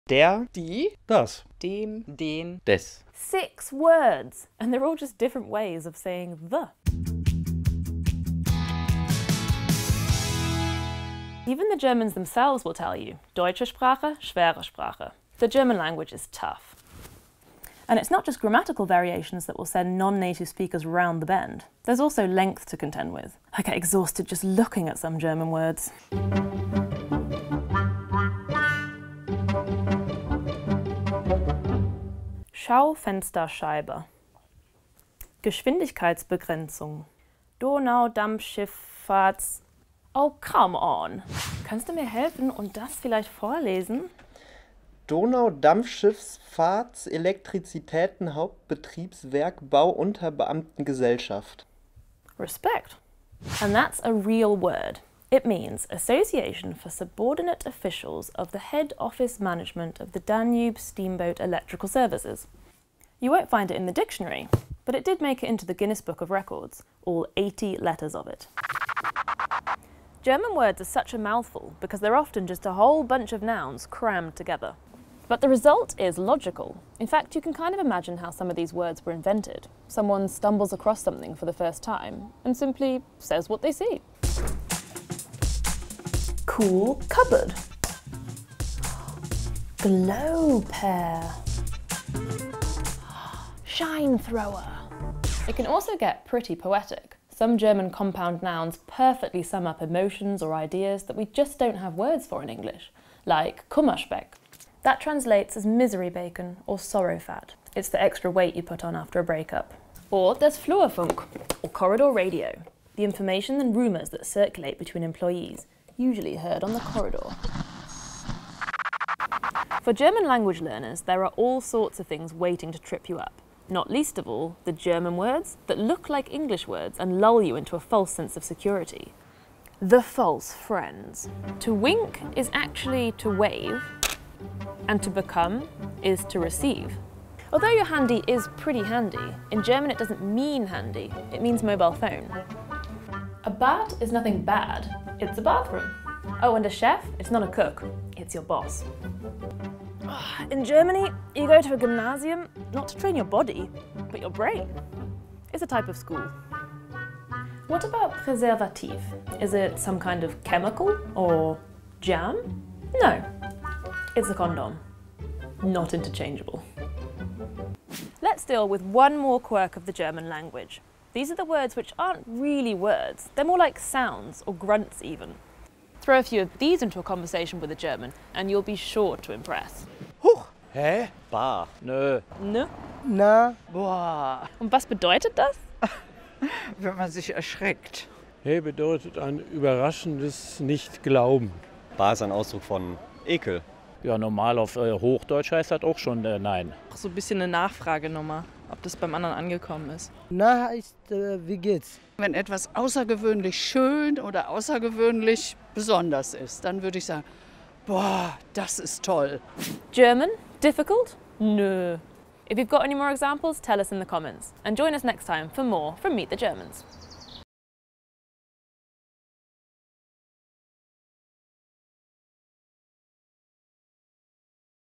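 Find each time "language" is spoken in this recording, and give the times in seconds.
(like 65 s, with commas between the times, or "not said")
15 s, 120 s, 170 s.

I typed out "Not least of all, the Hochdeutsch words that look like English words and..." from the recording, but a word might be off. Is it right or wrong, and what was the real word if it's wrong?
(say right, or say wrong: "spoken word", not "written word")
wrong: "German", not "Hochdeutsch".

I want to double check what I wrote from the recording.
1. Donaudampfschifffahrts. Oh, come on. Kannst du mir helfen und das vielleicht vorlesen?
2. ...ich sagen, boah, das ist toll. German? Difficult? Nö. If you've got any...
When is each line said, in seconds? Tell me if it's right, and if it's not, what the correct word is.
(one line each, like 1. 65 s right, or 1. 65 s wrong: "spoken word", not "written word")
1. 37 s right
2. 206 s right.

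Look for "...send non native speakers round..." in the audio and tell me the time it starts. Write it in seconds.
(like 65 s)
19 s.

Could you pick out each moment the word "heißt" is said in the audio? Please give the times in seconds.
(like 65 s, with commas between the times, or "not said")
195 s, 200 s.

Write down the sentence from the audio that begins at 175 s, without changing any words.
Throw a few of these into a conversation with a German and you'll be sure to impress.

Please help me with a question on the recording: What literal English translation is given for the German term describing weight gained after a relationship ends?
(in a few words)
misery bacon.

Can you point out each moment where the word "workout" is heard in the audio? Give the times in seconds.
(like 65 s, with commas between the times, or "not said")
not said.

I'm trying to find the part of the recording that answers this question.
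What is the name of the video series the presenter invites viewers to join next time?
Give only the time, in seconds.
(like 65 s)
216 s.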